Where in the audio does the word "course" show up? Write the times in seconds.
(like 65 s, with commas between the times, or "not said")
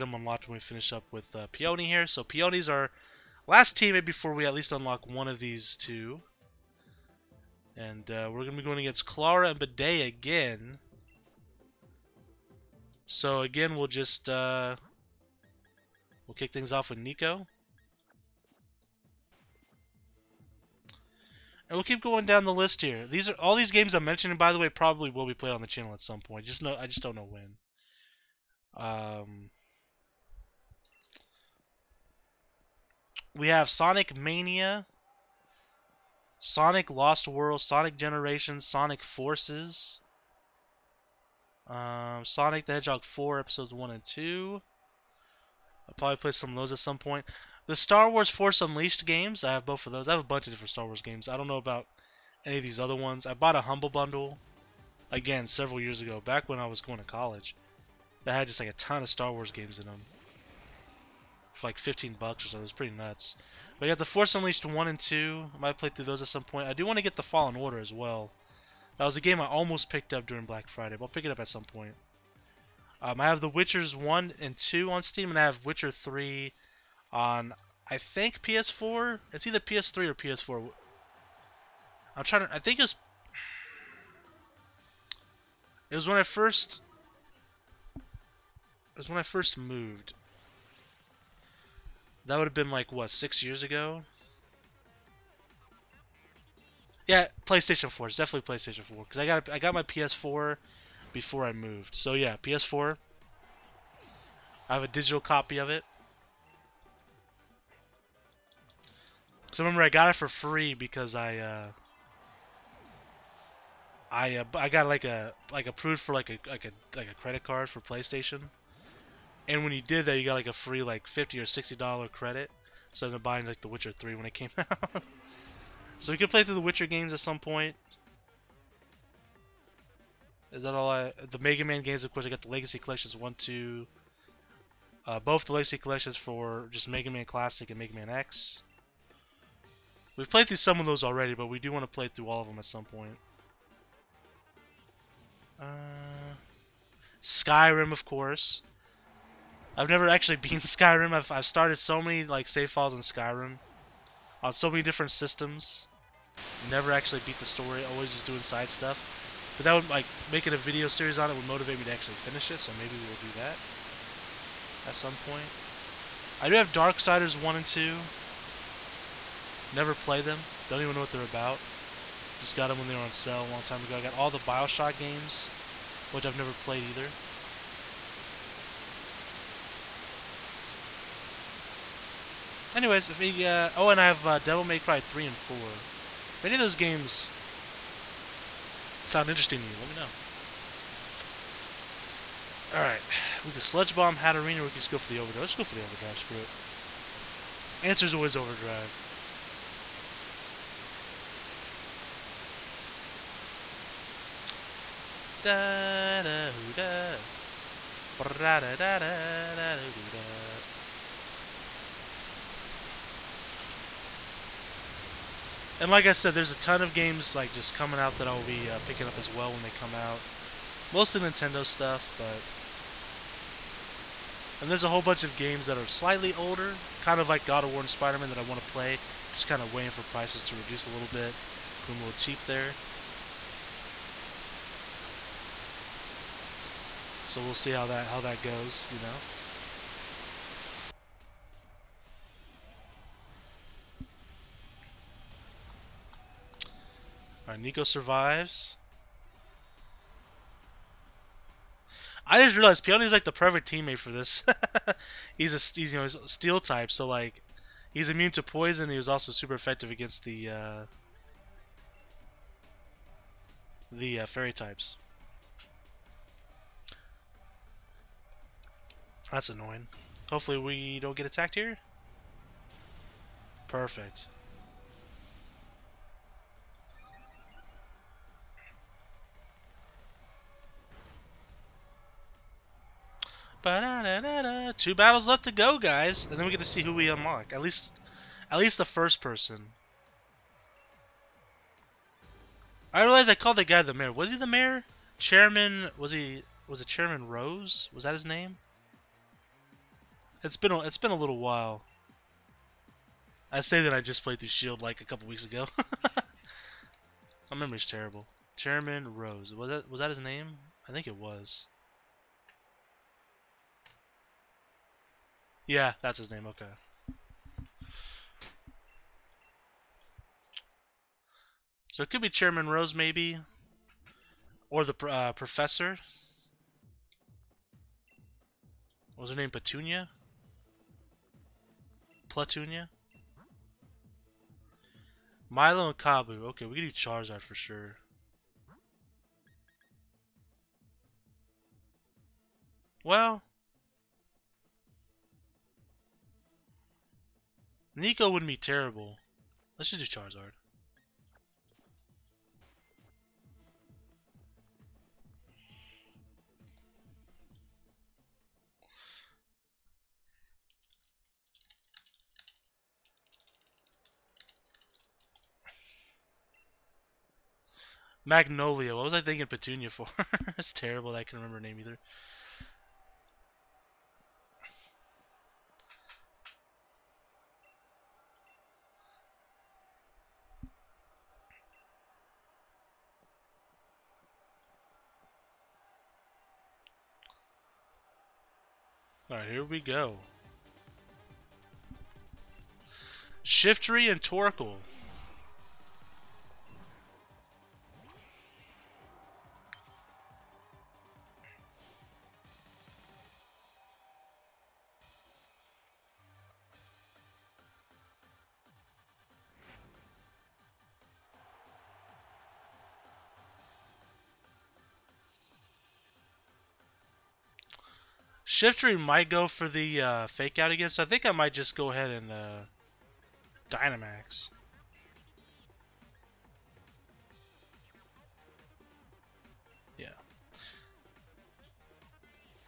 132 s, 148 s.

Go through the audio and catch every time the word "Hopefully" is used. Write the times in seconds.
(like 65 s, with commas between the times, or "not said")
270 s.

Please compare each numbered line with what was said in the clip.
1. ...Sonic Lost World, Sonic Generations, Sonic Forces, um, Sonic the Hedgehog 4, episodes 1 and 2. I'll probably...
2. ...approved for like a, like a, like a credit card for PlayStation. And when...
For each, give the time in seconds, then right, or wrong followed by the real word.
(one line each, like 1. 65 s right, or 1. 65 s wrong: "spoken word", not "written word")
1. 36 s right
2. 115 s right.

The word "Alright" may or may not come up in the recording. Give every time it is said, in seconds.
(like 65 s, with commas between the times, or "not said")
192 s, 247 s.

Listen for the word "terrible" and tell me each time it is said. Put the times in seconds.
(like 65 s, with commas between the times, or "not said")
307 s, 348 s, 370 s.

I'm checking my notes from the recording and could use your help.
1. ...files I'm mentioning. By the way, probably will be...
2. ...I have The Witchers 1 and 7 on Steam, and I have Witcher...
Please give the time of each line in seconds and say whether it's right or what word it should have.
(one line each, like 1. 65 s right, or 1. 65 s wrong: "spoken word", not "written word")
1. 23 s wrong: "games", not "files"
2. 73 s wrong: "2", not "7".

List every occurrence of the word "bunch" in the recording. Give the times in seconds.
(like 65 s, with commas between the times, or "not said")
50 s, 225 s.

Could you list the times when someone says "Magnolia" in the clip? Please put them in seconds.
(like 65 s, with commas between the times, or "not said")
368 s.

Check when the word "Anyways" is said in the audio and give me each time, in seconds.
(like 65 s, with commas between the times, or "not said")
182 s.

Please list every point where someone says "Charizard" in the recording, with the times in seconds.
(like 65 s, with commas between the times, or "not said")
336 s, 350 s.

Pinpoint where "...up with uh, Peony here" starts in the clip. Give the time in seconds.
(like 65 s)
0 s.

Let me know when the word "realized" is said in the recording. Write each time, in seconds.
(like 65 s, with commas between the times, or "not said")
252 s, 293 s.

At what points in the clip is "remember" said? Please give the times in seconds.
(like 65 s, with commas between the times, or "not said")
109 s, 371 s.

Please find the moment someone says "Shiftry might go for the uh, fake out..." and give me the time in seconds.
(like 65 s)
418 s.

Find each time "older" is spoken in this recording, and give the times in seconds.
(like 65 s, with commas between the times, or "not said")
226 s.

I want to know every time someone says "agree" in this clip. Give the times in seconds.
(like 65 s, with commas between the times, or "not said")
not said.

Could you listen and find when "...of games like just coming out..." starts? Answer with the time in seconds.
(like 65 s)
216 s.